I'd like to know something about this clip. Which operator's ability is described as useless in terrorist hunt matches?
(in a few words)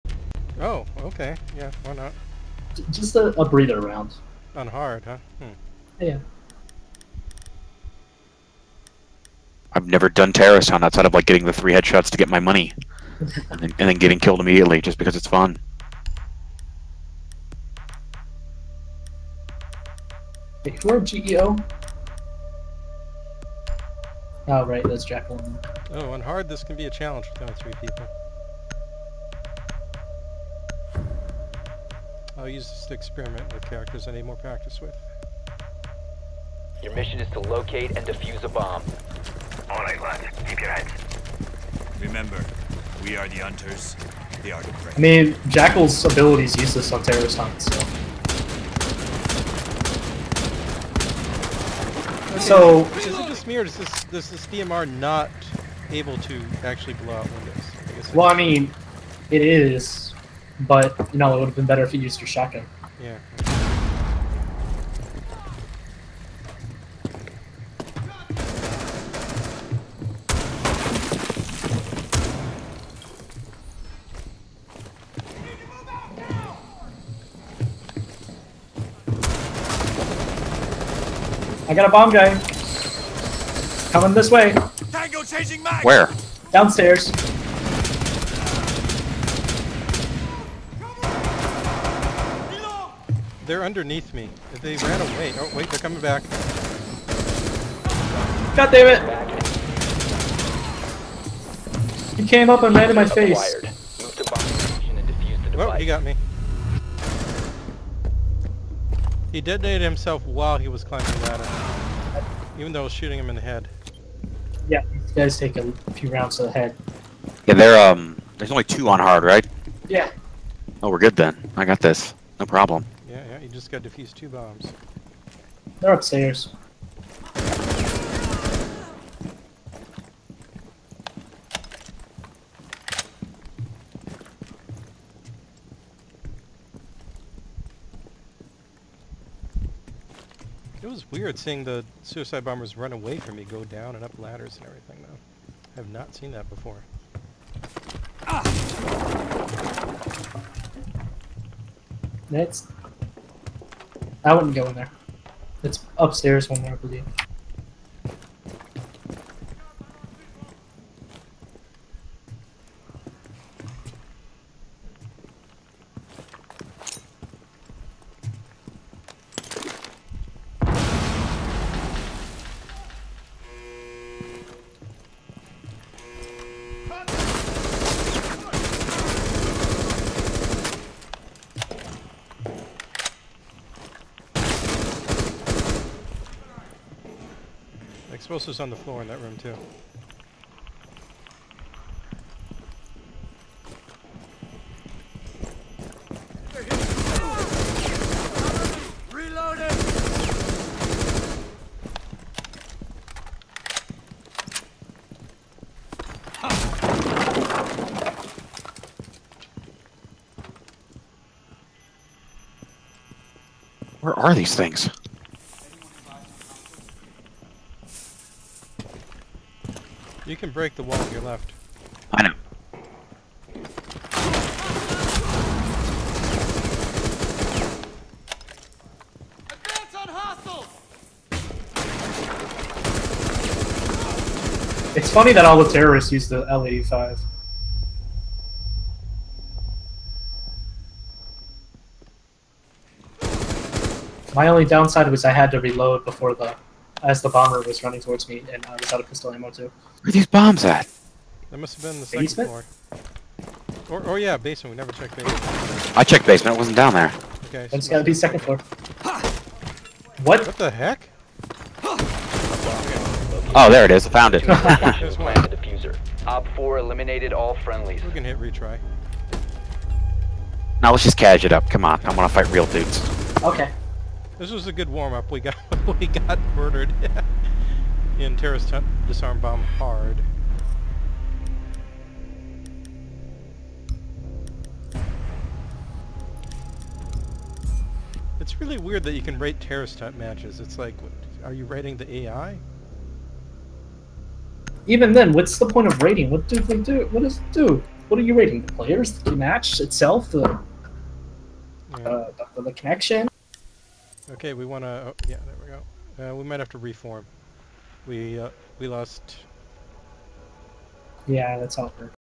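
Jackal.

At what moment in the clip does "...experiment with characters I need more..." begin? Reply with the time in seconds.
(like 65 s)
32 s.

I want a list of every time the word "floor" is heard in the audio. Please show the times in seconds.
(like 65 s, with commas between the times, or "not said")
188 s, 252 s, 258 s.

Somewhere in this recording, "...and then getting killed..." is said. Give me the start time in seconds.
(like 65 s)
13 s.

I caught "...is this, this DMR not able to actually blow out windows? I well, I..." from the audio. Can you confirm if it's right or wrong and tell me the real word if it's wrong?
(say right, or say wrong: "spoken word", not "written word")
right.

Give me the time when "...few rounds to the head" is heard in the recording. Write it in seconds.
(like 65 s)
115 s.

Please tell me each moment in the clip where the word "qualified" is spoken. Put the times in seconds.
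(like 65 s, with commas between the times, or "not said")
not said.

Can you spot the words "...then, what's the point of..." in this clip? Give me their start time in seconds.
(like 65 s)
295 s.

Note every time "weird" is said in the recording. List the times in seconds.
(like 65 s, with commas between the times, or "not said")
141 s, 288 s.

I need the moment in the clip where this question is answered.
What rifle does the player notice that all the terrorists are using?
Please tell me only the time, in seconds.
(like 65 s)
236 s.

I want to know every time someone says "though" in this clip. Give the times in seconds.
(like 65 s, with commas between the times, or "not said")
112 s, 145 s.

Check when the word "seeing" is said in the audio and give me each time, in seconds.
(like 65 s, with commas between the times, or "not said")
141 s.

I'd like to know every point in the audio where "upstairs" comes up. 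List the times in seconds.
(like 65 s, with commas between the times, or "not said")
125 s, 155 s.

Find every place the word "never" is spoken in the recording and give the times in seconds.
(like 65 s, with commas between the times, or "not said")
9 s, 254 s.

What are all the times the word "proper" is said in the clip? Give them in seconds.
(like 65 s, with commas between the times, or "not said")
not said.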